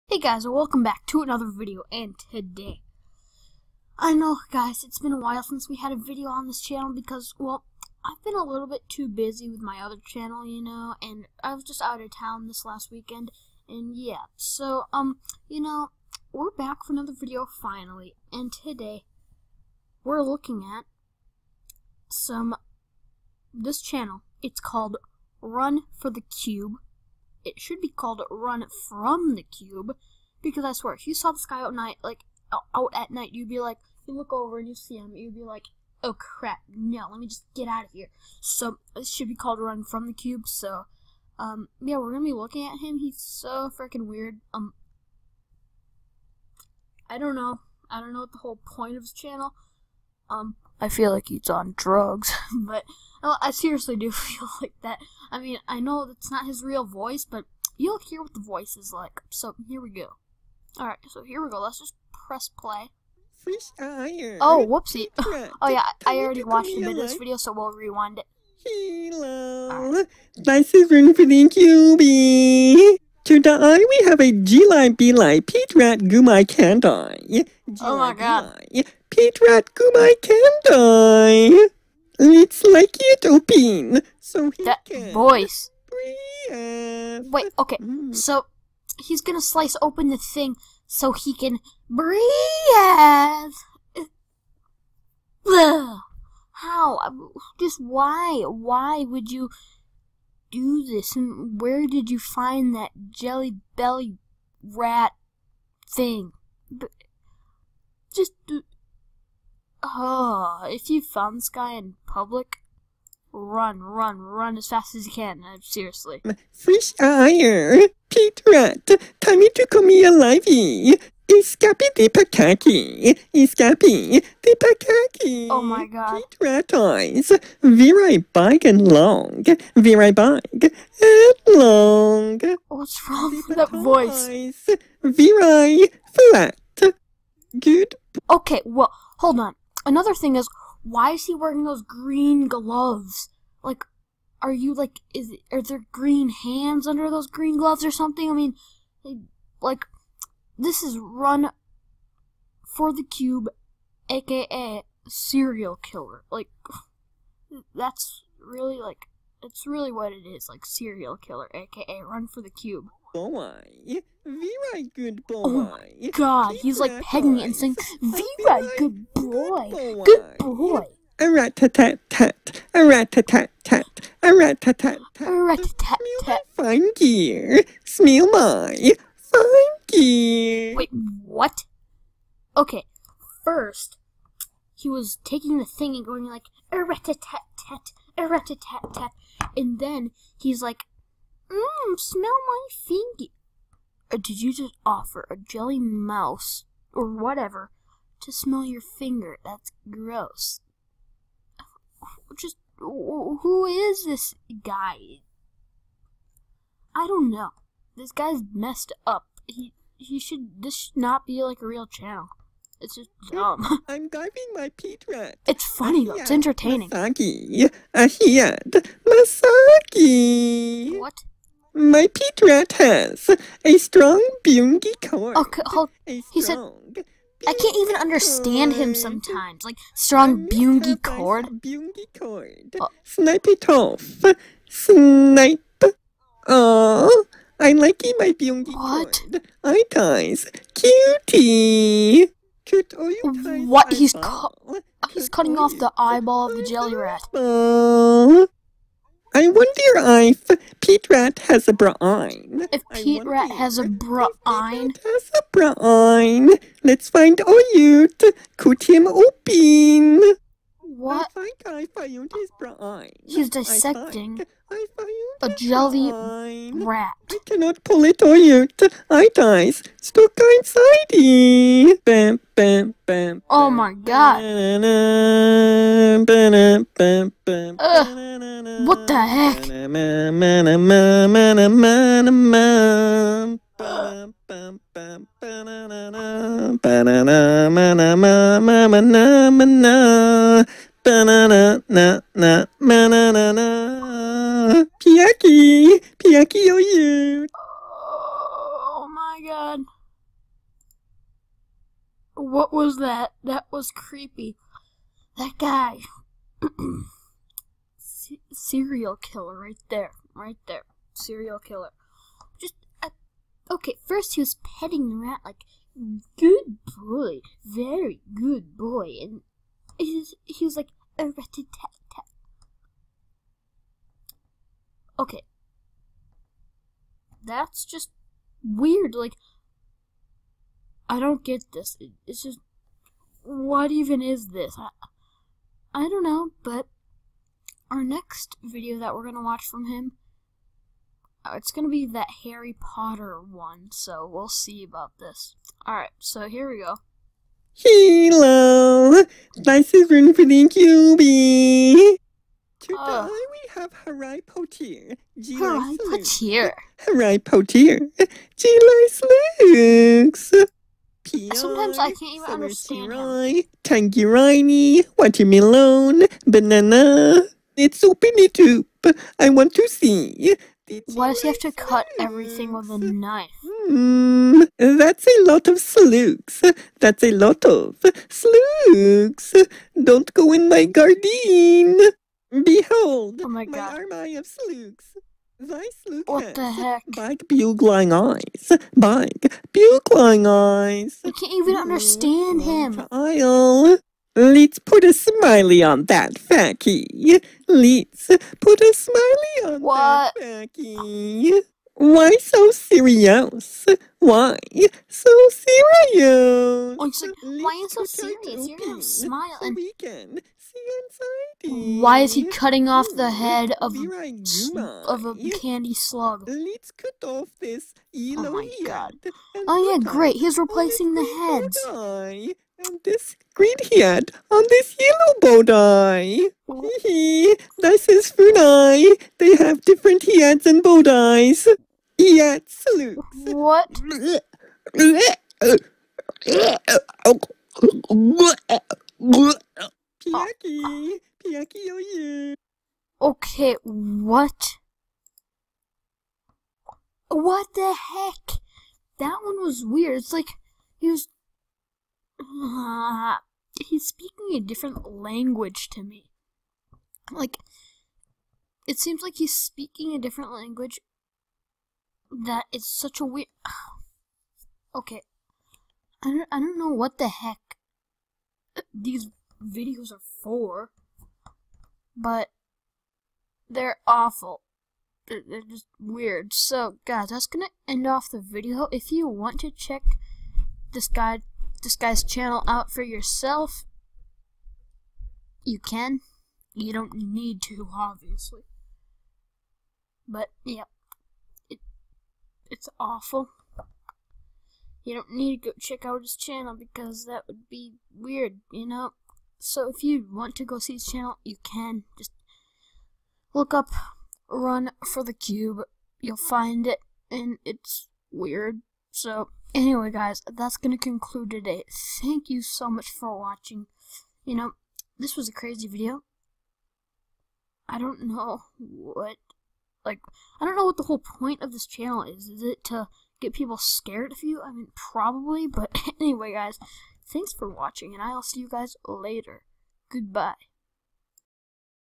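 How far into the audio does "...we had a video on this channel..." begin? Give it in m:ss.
0:05.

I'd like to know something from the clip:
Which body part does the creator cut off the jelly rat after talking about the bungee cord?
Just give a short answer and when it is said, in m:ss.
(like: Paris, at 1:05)
Eyeball, at 4:05.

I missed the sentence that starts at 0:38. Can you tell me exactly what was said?
So this should be called Run from the Cube.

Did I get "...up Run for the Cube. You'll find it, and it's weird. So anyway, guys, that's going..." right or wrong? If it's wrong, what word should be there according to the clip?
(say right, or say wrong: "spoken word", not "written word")
right.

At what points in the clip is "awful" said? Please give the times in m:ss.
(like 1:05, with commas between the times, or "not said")
7:54, 8:12.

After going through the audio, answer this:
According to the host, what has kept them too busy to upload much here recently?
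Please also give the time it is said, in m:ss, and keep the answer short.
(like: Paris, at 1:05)
Other channel, at 0:09.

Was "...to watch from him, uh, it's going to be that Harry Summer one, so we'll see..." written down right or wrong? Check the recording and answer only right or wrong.
wrong.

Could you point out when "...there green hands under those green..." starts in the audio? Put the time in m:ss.
2:25.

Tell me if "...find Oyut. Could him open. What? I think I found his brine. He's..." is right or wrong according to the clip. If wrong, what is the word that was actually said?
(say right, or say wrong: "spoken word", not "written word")
right.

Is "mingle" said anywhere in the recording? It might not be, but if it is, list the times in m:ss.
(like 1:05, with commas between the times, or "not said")
not said.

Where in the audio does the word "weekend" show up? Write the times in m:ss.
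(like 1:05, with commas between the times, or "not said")
0:12.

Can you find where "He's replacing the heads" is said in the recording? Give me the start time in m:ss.
7:00.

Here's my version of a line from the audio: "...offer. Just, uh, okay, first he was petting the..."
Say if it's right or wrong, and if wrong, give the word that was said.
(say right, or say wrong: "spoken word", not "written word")
wrong: "killer", not "offer".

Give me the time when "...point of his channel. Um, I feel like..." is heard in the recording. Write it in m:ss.
0:48.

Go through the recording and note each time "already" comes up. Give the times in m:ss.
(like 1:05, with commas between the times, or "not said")
1:06.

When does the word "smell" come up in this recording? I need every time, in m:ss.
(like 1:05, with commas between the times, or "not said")
2:57, 3:11, 3:18.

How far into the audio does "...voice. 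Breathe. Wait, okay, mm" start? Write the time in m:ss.
1:25.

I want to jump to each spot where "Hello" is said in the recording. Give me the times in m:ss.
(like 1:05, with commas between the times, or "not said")
1:08, 5:47.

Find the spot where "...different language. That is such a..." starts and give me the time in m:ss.
7:40.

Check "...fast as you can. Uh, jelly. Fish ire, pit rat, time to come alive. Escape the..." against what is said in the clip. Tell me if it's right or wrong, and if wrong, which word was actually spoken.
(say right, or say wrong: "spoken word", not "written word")
wrong: "seriously", not "jelly".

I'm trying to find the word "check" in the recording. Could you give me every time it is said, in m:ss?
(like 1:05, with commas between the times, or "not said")
7:59, 8:15.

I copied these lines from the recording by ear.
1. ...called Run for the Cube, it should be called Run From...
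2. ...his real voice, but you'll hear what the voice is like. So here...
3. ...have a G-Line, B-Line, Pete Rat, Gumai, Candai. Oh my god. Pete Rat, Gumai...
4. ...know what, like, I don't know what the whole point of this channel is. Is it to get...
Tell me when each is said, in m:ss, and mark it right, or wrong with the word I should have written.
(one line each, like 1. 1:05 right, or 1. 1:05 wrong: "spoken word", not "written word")
1. 0:24 right
2. 0:56 right
3. 1:14 right
4. 8:38 right.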